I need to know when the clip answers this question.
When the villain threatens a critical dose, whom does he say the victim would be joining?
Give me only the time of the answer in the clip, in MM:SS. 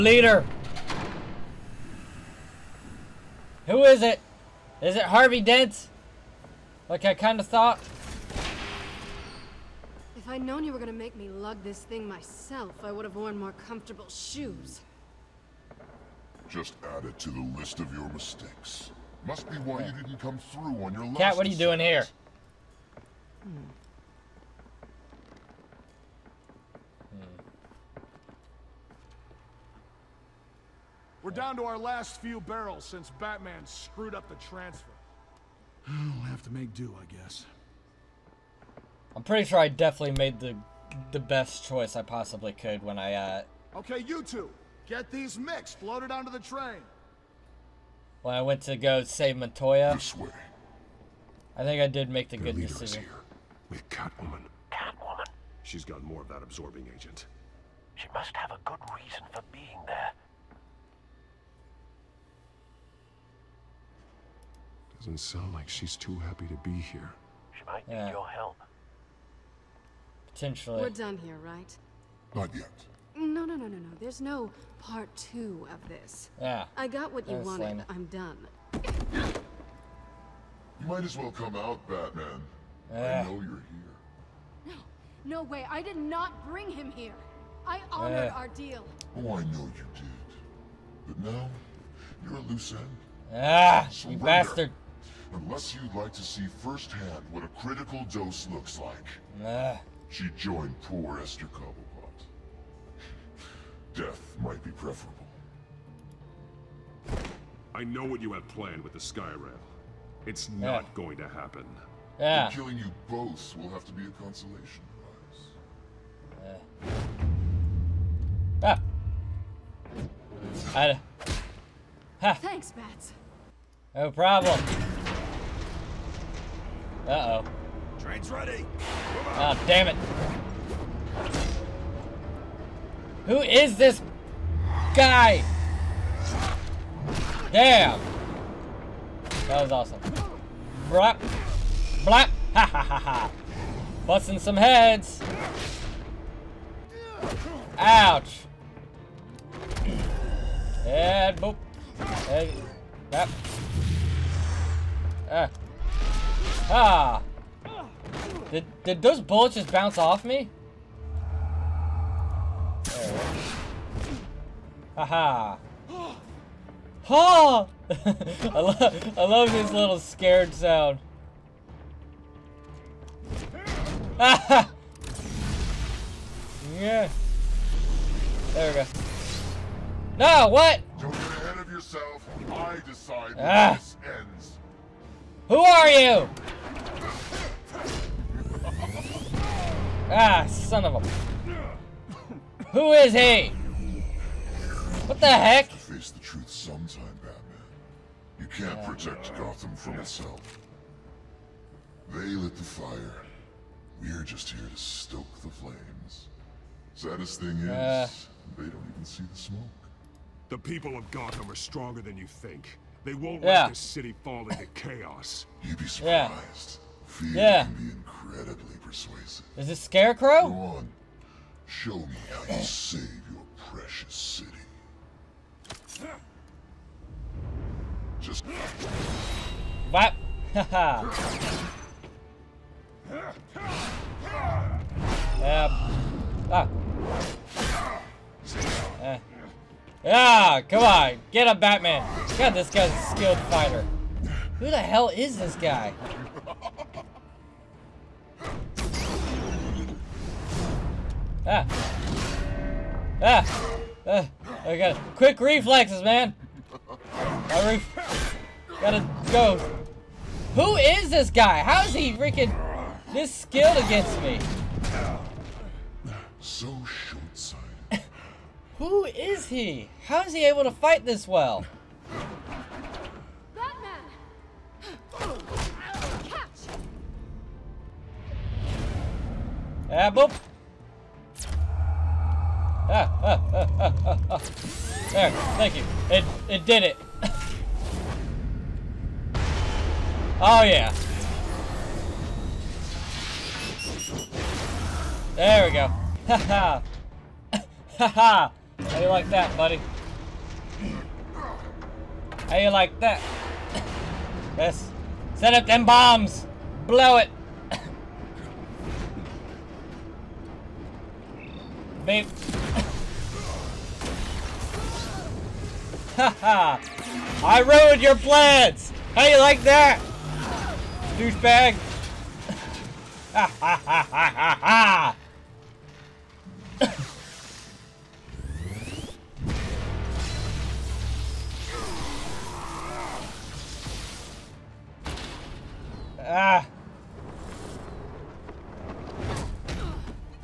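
01:41.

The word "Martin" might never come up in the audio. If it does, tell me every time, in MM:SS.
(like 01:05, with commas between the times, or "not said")
not said.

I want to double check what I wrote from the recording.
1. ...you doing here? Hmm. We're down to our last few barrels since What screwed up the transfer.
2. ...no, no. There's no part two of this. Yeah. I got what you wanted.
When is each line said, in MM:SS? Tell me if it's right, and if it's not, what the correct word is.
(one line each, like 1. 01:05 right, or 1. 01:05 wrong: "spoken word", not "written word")
1. 00:21 wrong: "Batman", not "What"
2. 01:13 right.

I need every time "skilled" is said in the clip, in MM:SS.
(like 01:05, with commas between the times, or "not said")
04:03, 04:23.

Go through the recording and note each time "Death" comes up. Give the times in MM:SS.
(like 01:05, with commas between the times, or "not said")
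01:43.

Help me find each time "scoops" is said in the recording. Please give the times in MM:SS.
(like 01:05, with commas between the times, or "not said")
not said.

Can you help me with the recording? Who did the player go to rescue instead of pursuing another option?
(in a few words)
Montoya.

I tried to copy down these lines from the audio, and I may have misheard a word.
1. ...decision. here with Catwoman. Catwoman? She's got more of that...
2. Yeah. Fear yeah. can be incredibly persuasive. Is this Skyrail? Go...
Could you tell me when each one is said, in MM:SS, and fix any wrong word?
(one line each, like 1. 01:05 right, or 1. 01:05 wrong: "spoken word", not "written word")
1. 00:52 right
2. 03:36 wrong: "Scarecrow", not "Skyrail".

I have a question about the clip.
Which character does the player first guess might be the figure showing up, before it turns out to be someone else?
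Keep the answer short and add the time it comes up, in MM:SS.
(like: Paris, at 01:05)
Harvey Dent, at 00:05.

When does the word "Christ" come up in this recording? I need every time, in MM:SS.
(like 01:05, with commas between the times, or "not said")
not said.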